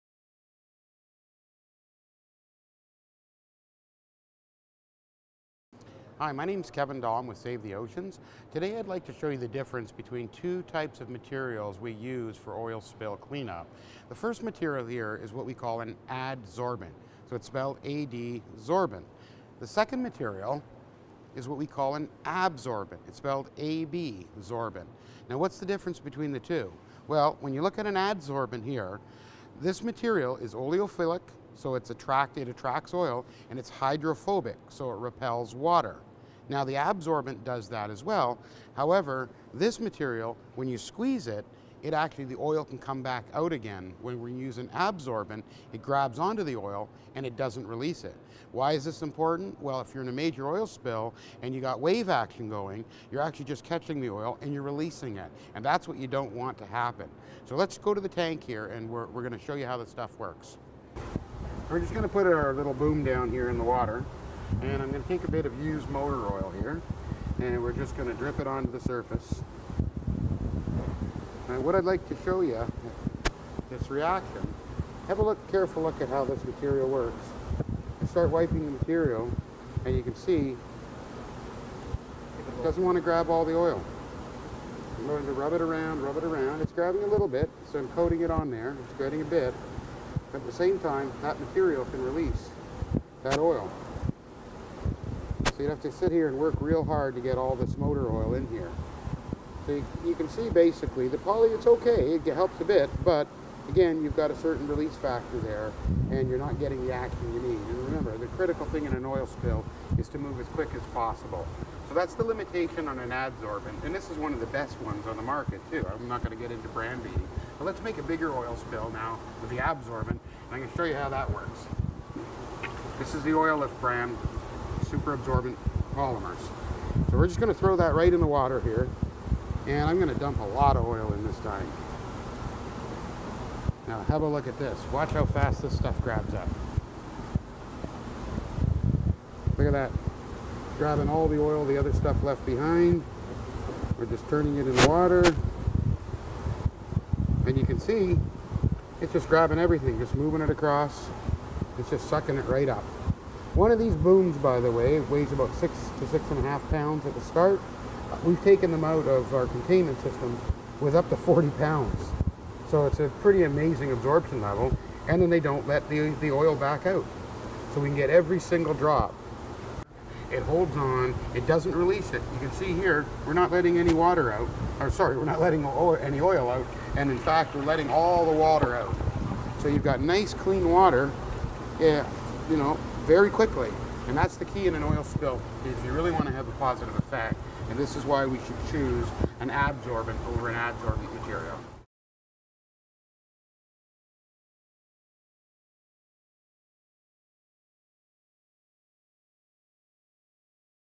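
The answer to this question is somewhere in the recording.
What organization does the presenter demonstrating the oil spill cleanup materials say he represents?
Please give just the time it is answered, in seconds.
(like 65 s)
7 s.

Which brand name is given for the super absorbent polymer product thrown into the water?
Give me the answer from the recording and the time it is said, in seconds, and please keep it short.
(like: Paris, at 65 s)
Oil Lift, at 123 s.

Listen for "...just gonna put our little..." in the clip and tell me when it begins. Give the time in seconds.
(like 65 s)
61 s.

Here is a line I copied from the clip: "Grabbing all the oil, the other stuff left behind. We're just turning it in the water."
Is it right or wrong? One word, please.
right.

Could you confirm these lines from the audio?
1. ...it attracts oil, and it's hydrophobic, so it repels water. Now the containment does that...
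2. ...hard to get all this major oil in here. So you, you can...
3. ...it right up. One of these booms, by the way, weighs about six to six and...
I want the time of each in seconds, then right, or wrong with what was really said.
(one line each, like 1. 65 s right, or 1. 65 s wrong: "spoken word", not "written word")
1. 32 s wrong: "absorbent", not "containment"
2. 96 s wrong: "motor", not "major"
3. 152 s right.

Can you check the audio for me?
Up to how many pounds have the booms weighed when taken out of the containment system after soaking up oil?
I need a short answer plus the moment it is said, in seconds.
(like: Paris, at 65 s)
40 pounds, at 161 s.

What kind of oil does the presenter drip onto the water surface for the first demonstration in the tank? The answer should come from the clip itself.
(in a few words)
used motor oil.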